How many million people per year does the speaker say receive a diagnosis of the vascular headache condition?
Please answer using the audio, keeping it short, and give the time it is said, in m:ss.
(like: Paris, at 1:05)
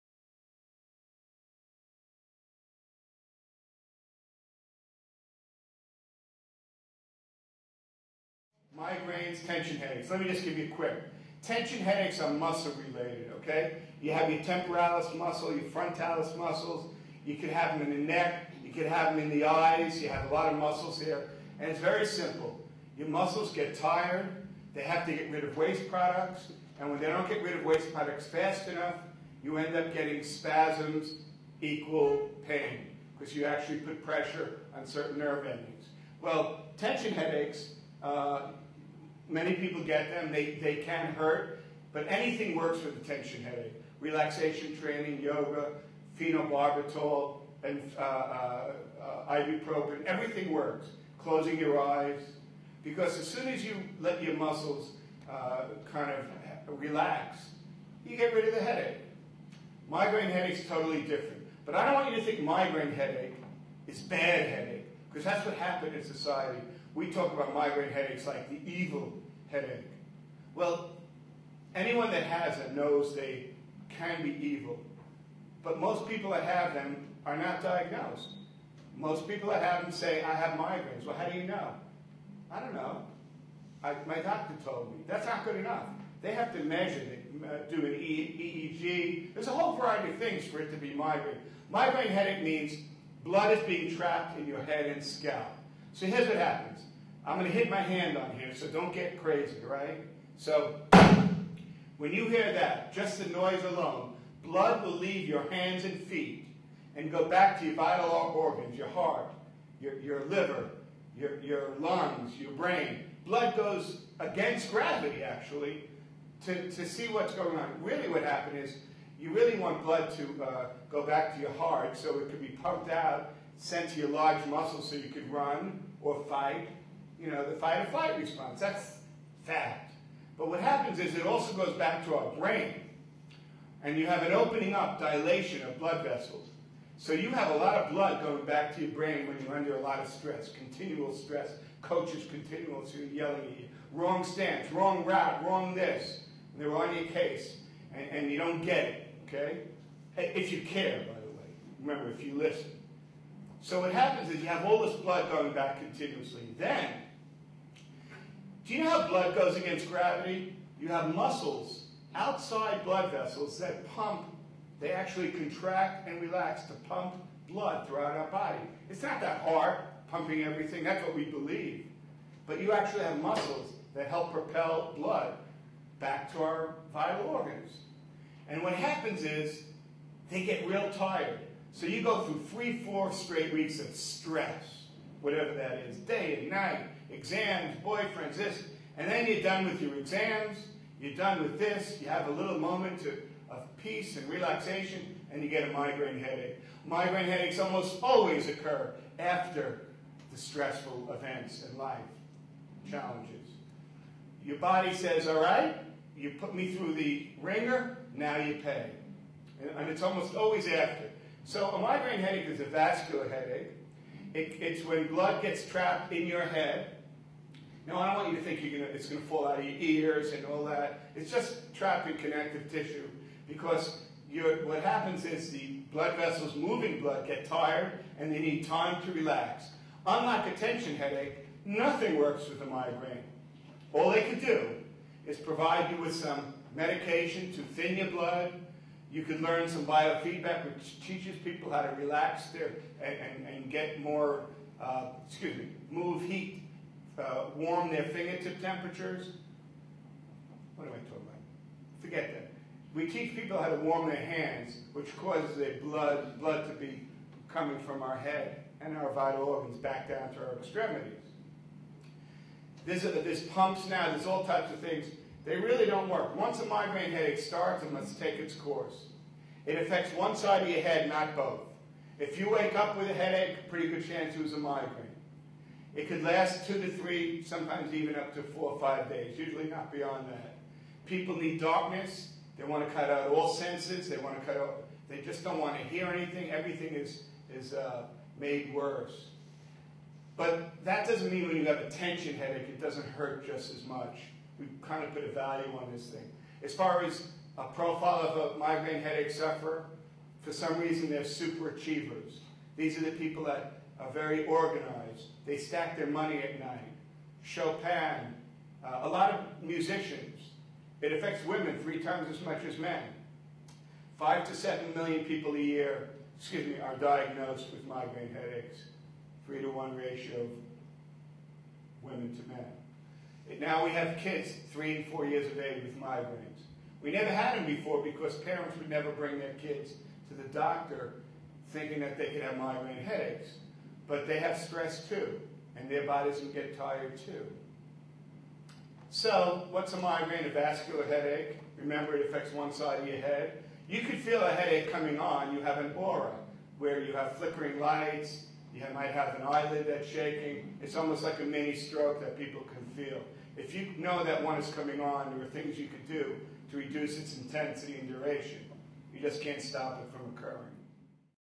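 5 to 7 million, at 5:14.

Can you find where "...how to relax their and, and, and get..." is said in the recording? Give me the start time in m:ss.
4:01.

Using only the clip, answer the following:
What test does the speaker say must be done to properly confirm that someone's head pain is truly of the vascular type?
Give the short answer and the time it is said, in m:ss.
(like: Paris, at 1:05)
EEG, at 1:27.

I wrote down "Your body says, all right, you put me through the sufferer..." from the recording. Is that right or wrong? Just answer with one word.
wrong.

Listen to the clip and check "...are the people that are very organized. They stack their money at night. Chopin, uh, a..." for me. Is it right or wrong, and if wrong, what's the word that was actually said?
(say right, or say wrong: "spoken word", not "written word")
right.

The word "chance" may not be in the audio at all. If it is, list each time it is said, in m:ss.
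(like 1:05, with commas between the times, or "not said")
4:34.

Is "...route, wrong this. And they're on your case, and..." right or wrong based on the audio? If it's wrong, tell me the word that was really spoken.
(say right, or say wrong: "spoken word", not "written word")
right.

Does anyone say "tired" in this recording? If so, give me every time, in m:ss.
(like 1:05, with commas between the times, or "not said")
0:23, 3:00, 3:47, 5:36.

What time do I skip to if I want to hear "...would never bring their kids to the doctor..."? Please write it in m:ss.
5:28.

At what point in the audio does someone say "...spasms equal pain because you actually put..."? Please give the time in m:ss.
0:30.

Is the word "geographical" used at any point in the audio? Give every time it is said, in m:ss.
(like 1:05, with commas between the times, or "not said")
not said.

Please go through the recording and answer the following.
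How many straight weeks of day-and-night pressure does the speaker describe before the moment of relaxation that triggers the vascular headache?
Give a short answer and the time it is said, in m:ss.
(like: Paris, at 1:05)
3 or 4, at 3:02.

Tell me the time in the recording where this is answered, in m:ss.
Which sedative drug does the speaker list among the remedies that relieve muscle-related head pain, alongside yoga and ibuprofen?
0:46.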